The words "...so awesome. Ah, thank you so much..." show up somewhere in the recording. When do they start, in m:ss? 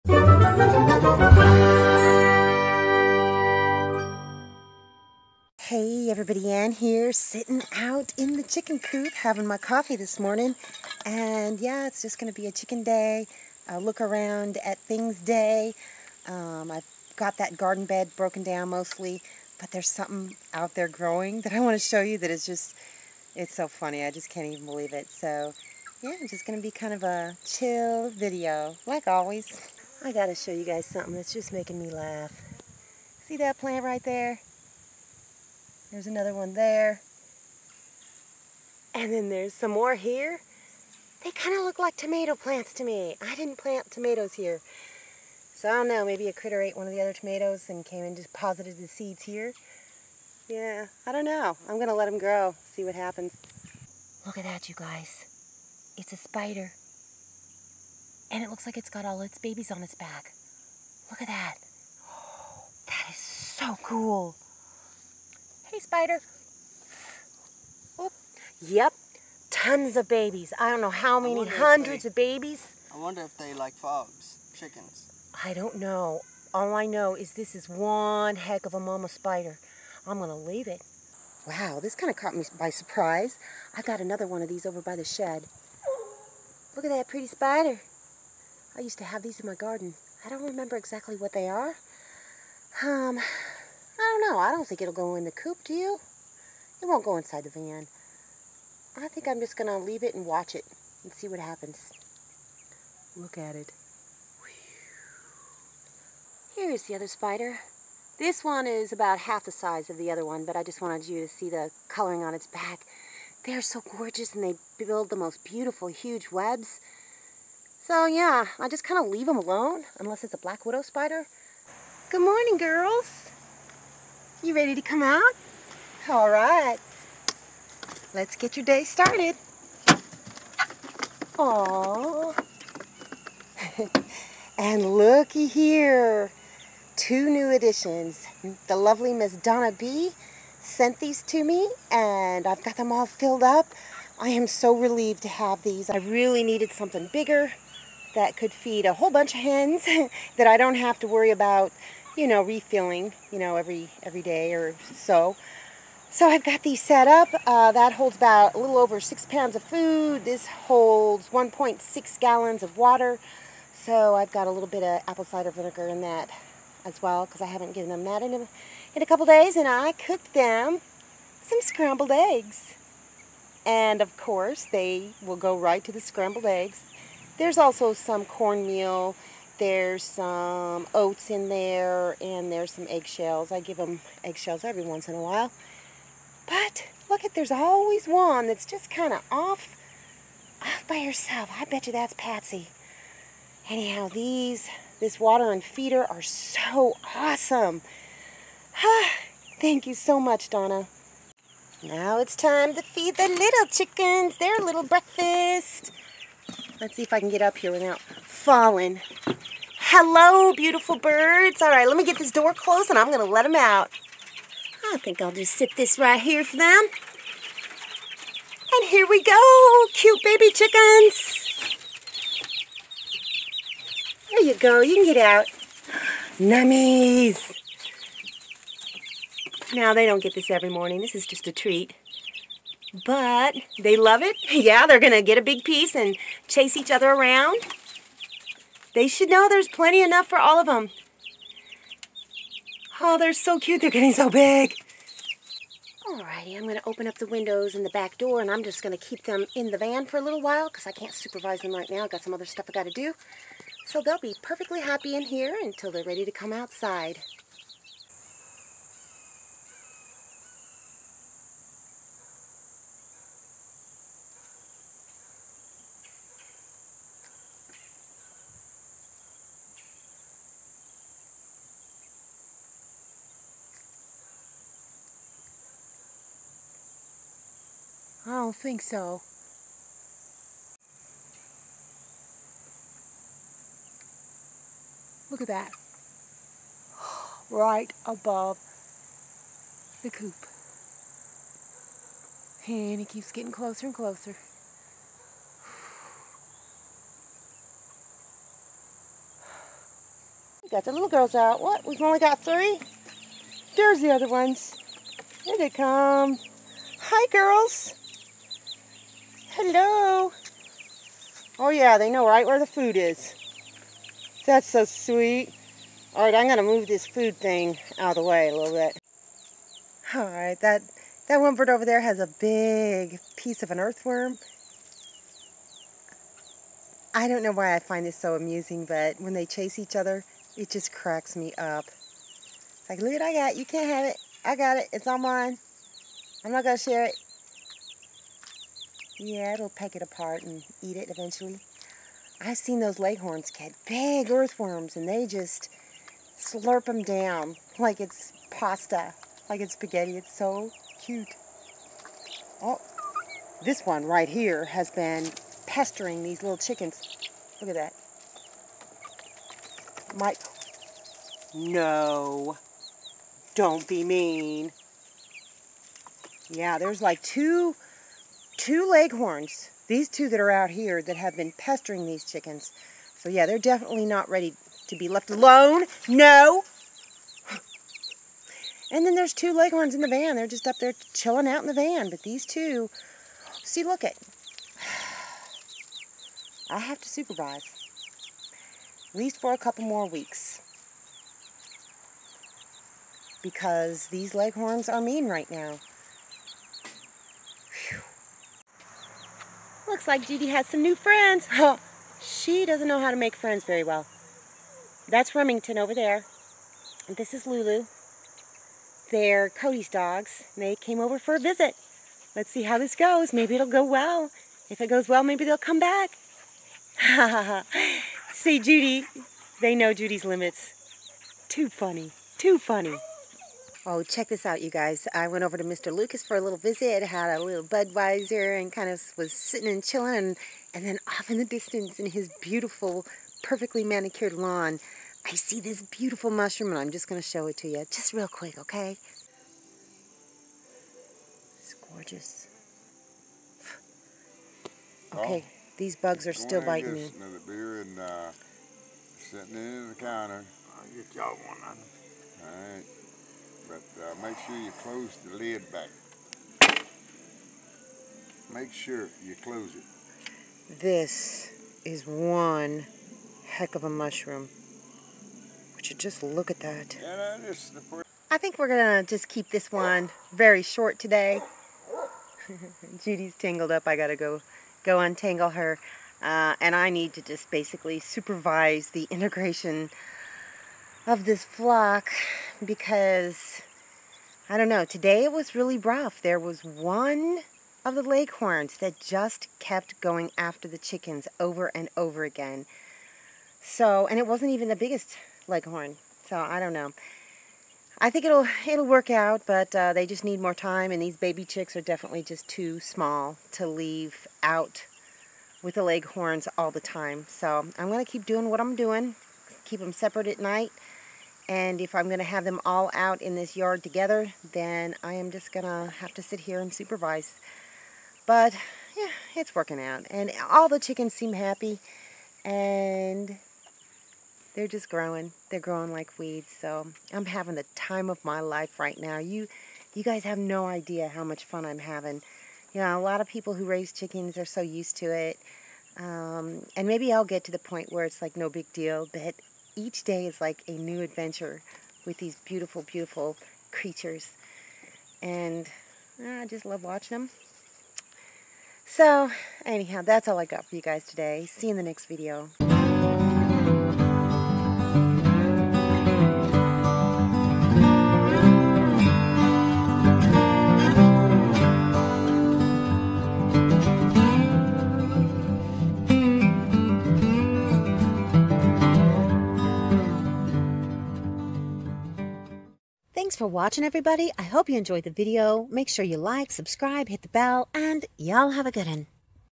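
3:16.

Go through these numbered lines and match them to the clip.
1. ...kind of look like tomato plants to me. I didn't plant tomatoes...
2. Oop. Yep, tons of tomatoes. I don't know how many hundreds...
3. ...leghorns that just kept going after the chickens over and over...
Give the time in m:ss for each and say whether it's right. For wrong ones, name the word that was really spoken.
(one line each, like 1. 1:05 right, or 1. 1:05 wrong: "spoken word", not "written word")
1. 0:41 right
2. 1:07 wrong: "babies", not "tomatoes"
3. 8:08 right.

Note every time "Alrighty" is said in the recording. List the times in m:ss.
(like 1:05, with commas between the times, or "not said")
4:06.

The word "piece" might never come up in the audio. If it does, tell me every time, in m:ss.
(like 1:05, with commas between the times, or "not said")
3:55, 5:23.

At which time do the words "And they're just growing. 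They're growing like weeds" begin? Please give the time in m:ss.
8:42.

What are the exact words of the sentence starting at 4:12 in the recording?
I've got some other stuff i got to do.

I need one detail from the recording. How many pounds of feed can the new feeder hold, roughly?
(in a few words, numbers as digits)
6.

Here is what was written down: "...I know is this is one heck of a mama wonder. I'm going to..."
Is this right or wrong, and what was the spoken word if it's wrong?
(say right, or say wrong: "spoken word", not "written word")
wrong: "spider", not "wonder".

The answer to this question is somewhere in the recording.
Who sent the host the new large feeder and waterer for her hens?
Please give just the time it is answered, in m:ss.
2:19.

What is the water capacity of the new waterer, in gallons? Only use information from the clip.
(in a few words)
1.6.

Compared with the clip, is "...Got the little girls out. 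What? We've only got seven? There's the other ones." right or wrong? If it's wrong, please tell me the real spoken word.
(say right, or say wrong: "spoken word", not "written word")
wrong: "three", not "seven".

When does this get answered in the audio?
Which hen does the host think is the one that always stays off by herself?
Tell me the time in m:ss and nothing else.
3:12.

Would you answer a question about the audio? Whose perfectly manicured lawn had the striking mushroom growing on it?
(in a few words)
Mr. Lucas.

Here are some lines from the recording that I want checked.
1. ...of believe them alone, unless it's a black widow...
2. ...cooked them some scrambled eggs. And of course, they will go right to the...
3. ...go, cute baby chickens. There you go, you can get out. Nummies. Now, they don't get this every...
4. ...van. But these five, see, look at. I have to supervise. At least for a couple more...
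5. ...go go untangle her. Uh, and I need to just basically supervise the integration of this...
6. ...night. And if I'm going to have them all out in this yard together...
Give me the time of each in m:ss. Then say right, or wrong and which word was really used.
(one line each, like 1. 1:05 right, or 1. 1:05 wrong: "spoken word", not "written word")
1. 1:59 wrong: "leave", not "believe"
2. 2:49 right
3. 3:39 right
4. 6:21 wrong: "two", not "five"
5. 7:54 right
6. 8:30 right.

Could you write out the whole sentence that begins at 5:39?
Yeah, it'll peck it apart and eat it eventually.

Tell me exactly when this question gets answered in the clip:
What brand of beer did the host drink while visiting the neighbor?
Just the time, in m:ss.
7:07.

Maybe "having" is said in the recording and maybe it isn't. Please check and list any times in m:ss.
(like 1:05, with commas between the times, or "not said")
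0:09, 8:47, 8:51.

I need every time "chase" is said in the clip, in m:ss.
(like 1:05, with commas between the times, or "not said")
3:56, 5:29.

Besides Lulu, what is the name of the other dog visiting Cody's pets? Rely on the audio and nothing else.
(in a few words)
Remington.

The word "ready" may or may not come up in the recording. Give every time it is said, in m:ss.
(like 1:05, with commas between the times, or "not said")
2:04, 4:16, 6:14.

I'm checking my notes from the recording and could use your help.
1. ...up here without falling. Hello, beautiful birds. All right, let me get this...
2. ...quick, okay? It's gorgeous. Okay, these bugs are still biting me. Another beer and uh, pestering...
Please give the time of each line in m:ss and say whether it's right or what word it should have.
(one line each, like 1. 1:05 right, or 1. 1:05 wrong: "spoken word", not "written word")
1. 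3:27 right
2. 7:18 wrong: "sitting", not "pestering".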